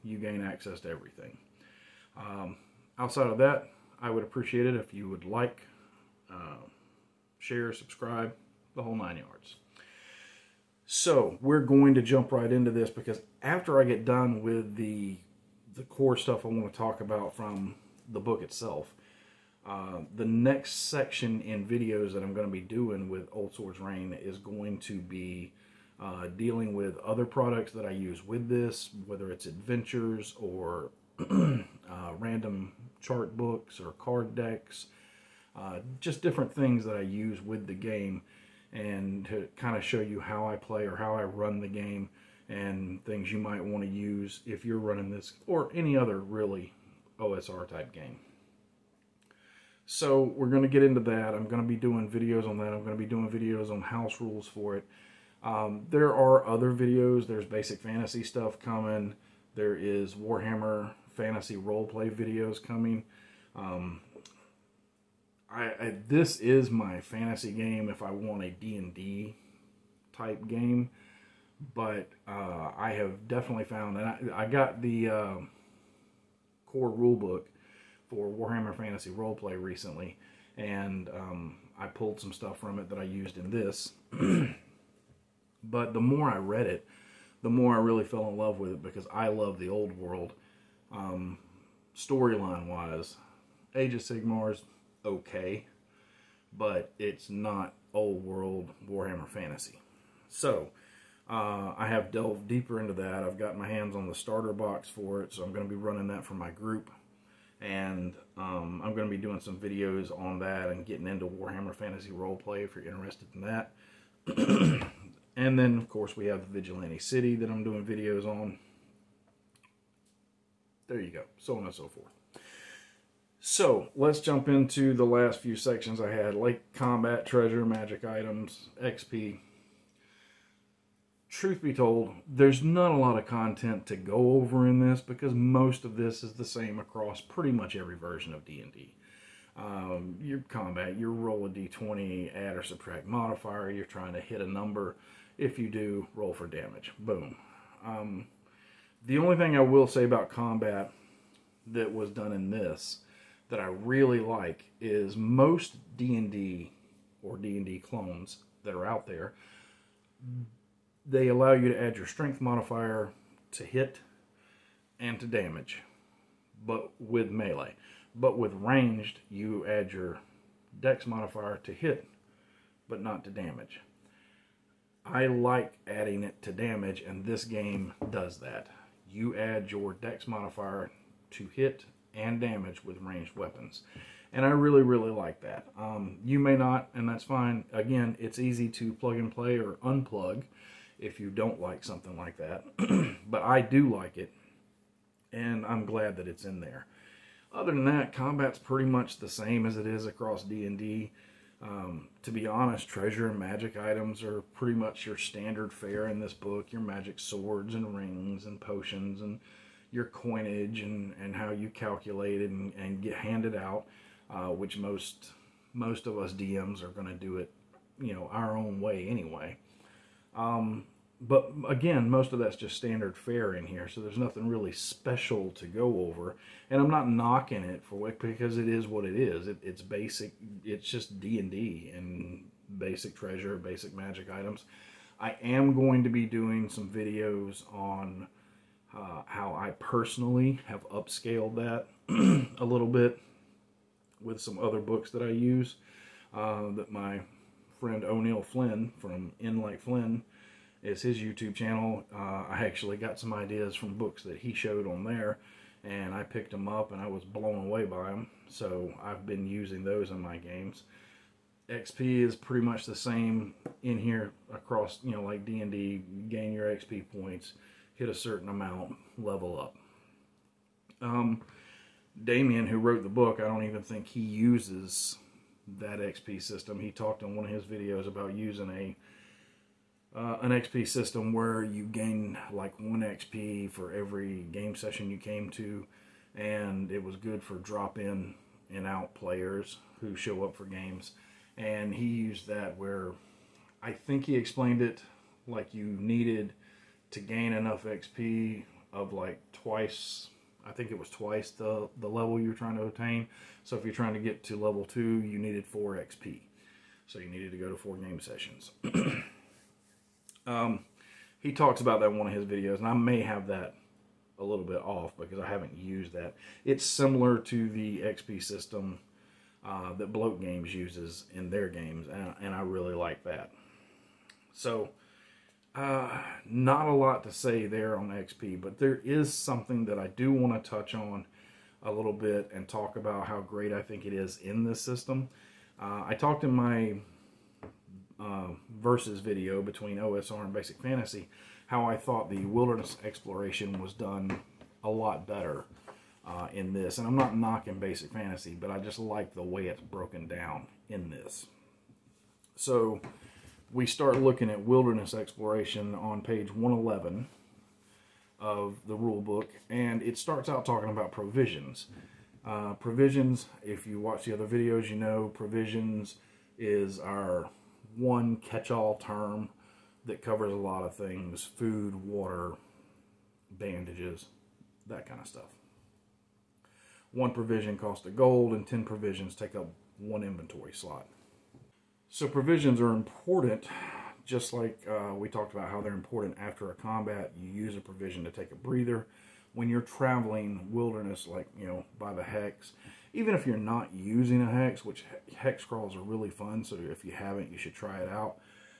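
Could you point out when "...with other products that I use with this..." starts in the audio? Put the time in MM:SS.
00:26.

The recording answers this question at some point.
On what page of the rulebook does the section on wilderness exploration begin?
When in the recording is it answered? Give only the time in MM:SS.
05:56.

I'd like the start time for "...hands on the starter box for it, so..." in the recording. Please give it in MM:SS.
01:43.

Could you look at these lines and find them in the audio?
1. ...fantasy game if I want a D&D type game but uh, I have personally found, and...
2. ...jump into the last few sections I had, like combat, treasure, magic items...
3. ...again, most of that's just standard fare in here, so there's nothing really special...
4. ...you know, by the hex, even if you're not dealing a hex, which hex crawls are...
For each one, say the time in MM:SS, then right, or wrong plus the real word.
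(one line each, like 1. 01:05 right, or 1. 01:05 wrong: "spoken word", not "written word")
1. 01:07 wrong: "definitely", not "personally"
2. 02:04 right
3. 03:41 right
4. 06:31 wrong: "using", not "dealing".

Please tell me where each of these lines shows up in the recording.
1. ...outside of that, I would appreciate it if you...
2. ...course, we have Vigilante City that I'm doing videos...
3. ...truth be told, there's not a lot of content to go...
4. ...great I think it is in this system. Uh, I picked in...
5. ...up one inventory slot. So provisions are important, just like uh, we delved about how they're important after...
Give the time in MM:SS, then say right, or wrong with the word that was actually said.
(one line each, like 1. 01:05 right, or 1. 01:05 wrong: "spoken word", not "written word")
1. 00:02 right
2. 01:55 right
3. 02:11 right
4. 05:33 wrong: "talked", not "picked"
5. 06:19 wrong: "talked", not "delved".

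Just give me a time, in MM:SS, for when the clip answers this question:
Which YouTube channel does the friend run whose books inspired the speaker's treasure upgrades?
04:09.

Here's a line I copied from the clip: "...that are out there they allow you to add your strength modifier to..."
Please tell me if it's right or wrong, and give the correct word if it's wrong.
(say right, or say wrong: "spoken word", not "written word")
right.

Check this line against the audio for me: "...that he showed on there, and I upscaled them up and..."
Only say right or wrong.
wrong.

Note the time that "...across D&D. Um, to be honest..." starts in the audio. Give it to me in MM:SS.
03:20.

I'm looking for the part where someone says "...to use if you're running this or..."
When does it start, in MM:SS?
00:43.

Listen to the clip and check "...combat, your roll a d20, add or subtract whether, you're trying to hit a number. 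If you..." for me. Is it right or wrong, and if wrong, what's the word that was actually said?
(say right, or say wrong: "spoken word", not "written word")
wrong: "modifier", not "whether".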